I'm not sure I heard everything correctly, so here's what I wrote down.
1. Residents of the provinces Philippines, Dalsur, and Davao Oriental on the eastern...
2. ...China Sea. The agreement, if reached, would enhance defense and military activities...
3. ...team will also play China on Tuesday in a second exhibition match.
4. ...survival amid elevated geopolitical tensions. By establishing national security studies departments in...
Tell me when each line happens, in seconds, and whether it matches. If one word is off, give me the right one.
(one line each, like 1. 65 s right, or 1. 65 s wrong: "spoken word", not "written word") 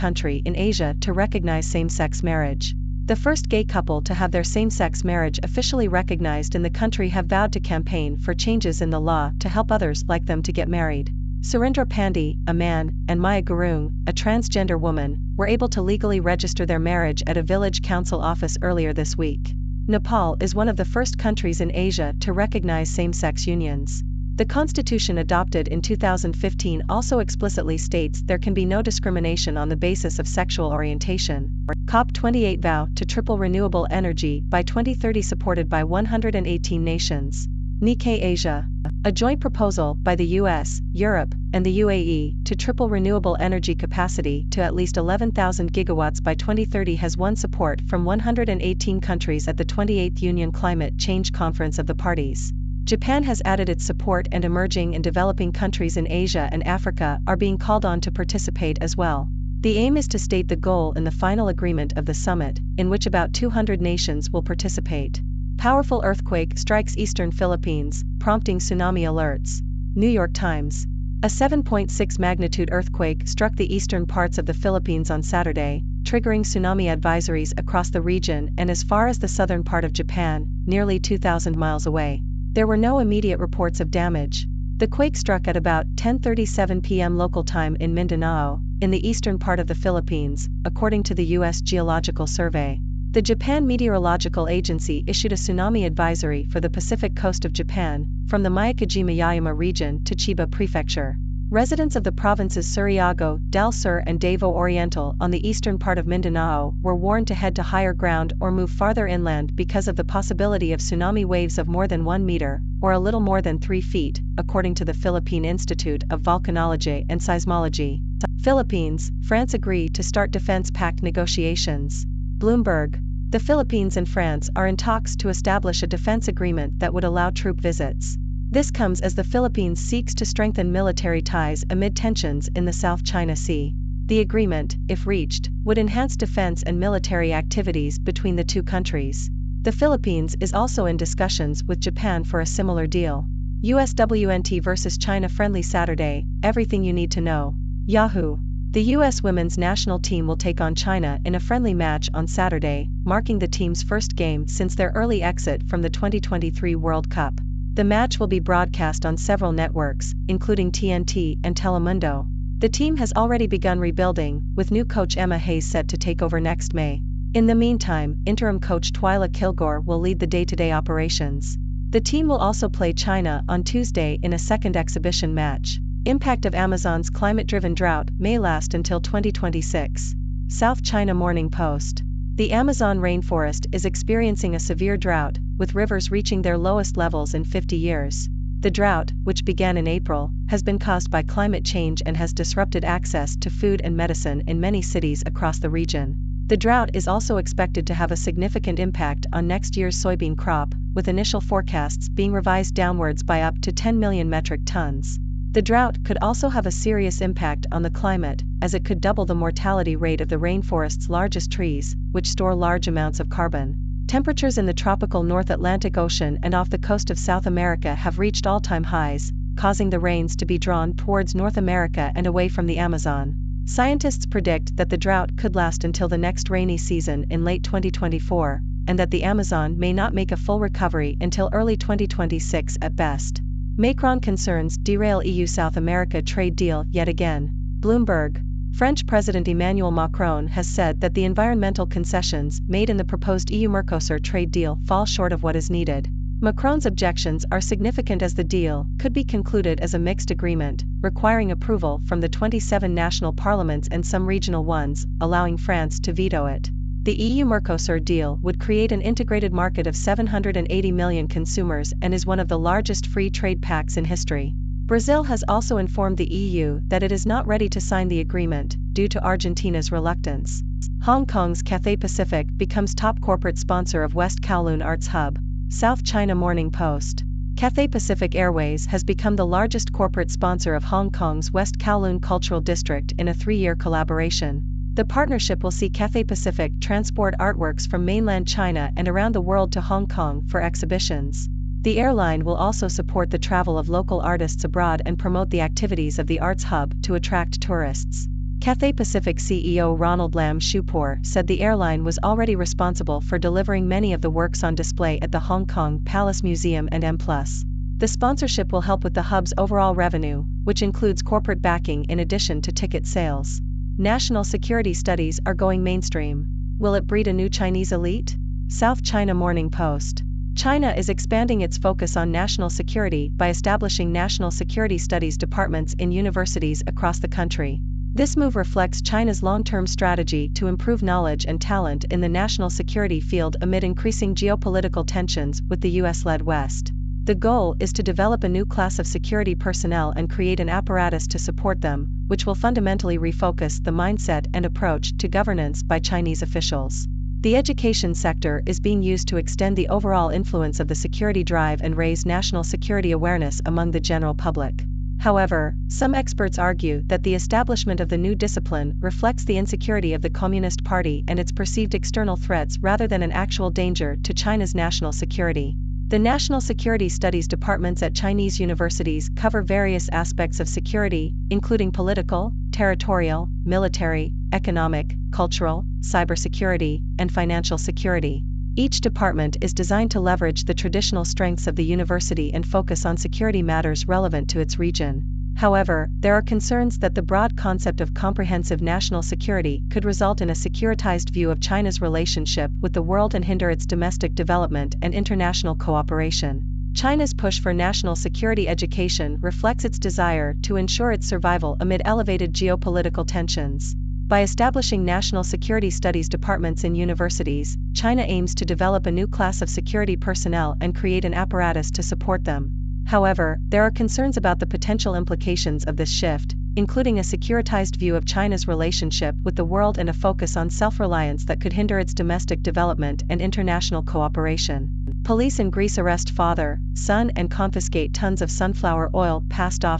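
1. 101 s wrong: "Surigao", not "Philippines"
2. 133 s right
3. 172 s right
4. 401 s right.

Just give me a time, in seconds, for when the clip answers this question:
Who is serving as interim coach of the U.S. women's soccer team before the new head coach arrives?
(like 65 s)
168 s.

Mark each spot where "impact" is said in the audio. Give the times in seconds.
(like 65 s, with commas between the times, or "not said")
176 s, 198 s, 207 s.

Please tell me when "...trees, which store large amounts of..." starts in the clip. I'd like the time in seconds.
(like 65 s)
211 s.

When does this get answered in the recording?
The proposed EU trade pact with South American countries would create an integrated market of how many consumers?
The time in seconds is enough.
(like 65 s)
259 s.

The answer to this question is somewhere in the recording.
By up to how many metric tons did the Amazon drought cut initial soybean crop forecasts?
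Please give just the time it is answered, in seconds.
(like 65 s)
203 s.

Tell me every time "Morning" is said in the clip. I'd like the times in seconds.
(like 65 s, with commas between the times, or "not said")
181 s, 276 s, 319 s.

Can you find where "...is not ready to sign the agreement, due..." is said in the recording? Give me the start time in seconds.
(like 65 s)
267 s.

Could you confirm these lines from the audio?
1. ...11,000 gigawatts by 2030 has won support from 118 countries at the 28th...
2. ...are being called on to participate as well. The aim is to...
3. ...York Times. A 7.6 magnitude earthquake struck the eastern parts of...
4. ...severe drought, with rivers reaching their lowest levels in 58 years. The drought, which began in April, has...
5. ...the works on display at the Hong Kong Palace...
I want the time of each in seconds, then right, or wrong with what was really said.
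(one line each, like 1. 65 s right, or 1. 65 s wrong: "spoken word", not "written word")
1. 44 s right
2. 57 s right
3. 70 s right
4. 184 s wrong: "50", not "58"
5. 304 s right.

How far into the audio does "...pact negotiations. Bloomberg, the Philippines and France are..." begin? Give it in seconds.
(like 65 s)
120 s.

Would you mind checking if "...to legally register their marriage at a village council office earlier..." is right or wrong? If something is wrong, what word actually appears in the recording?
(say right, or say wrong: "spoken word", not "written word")
right.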